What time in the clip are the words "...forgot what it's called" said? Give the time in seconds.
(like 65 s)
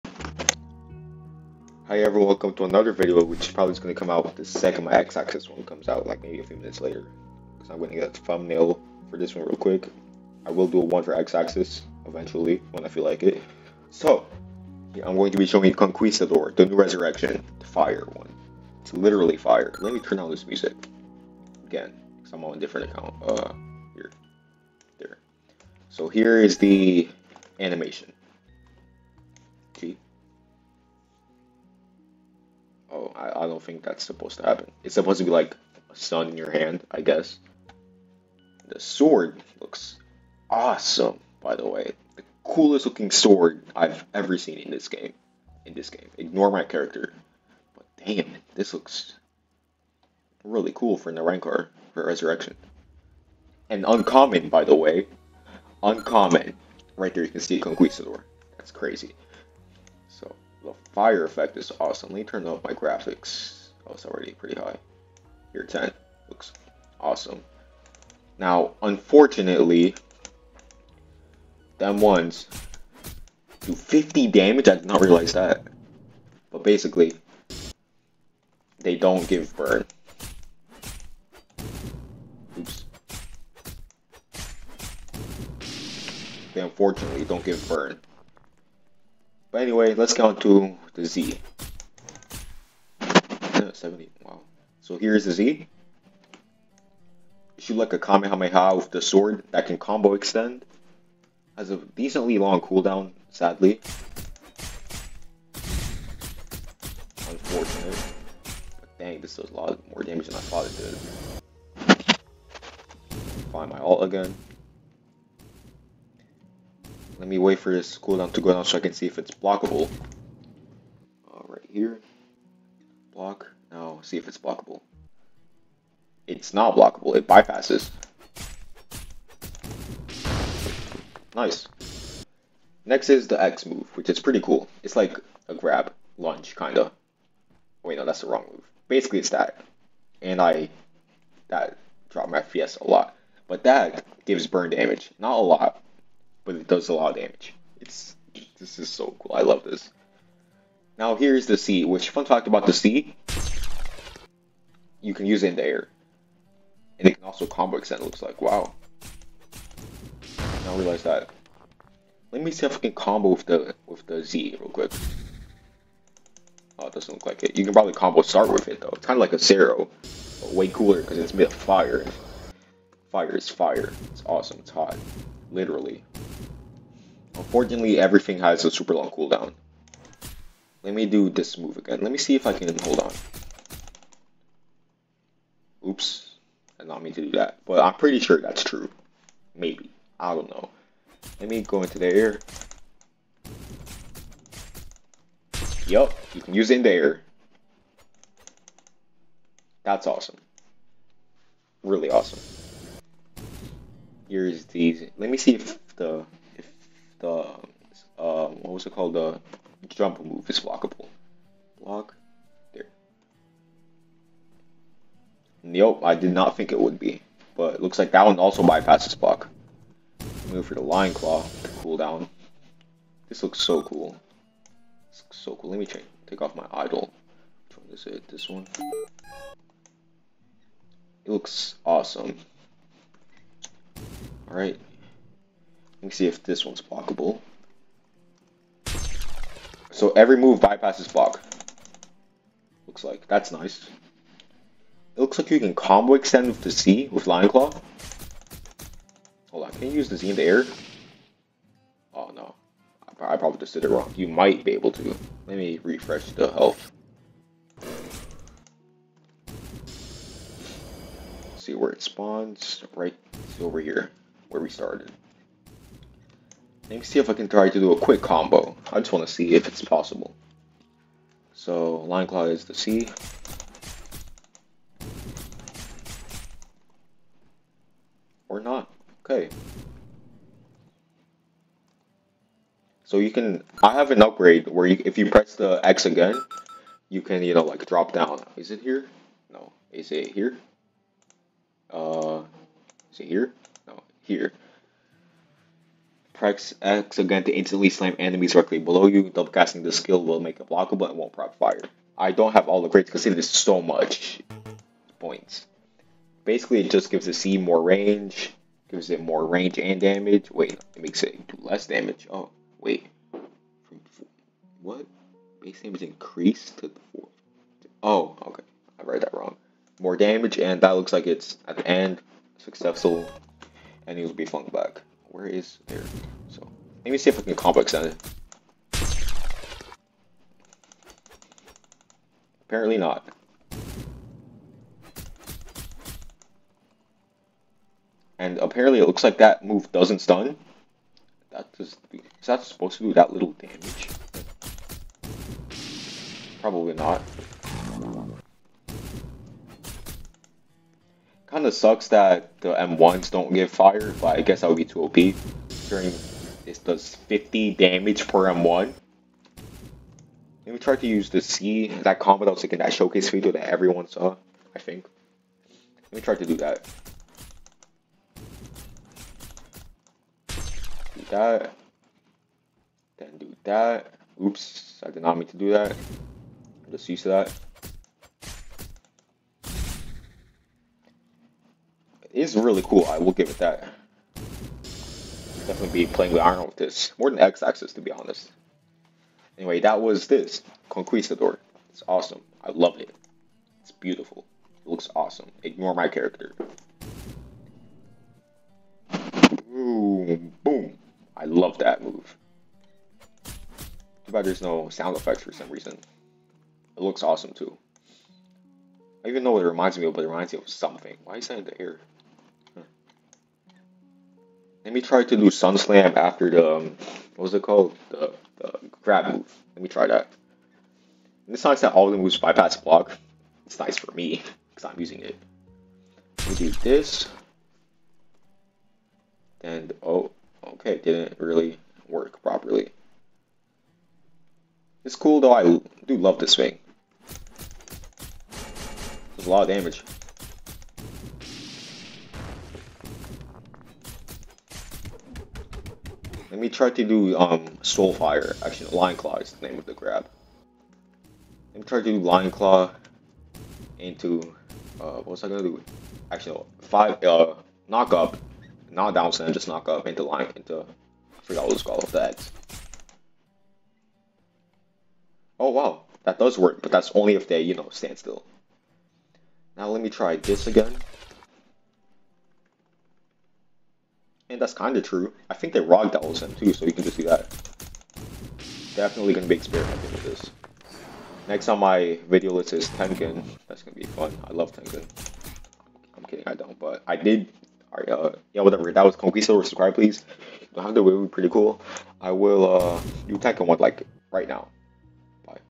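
461 s.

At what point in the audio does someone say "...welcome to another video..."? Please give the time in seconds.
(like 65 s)
2 s.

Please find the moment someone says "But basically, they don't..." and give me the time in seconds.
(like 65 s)
76 s.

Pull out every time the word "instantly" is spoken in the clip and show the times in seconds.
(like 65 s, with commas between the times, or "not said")
297 s.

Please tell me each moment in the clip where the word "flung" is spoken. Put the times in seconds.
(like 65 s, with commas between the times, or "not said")
324 s.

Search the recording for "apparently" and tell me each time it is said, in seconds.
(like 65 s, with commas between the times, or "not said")
332 s, 338 s.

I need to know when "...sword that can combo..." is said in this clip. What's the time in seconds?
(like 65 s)
99 s.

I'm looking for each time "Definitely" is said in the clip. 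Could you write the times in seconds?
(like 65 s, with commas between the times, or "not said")
385 s, 478 s.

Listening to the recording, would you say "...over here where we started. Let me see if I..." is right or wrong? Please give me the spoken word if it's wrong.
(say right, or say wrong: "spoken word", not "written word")
right.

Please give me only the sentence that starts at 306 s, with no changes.
Basically, it just gives the C more range, gives it more range and damage.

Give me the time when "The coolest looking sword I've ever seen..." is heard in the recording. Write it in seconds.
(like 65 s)
42 s.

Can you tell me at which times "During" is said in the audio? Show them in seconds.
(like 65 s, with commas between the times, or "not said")
355 s.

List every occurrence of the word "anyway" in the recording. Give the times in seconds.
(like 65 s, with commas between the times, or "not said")
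89 s, 389 s.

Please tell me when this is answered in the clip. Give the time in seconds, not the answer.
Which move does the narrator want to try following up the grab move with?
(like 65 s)
415 s.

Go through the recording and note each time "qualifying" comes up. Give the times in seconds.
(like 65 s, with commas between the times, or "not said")
not said.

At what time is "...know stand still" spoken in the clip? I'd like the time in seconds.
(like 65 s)
467 s.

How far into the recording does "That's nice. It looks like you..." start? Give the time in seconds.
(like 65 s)
243 s.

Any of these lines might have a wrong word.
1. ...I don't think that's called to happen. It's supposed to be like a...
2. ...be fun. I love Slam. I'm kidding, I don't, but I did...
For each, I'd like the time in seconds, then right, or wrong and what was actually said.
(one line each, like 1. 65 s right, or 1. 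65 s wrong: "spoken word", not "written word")
1. 33 s wrong: "supposed", not "called"
2. 484 s wrong: "Tengen", not "Slam".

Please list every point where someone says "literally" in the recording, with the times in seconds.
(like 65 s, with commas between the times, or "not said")
18 s, 175 s.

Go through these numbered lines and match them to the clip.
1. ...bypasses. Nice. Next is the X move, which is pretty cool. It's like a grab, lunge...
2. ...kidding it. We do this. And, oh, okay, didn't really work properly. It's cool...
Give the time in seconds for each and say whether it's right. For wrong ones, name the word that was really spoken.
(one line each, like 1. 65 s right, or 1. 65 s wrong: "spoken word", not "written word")
1. 127 s right
2. 424 s wrong: "using", not "kidding".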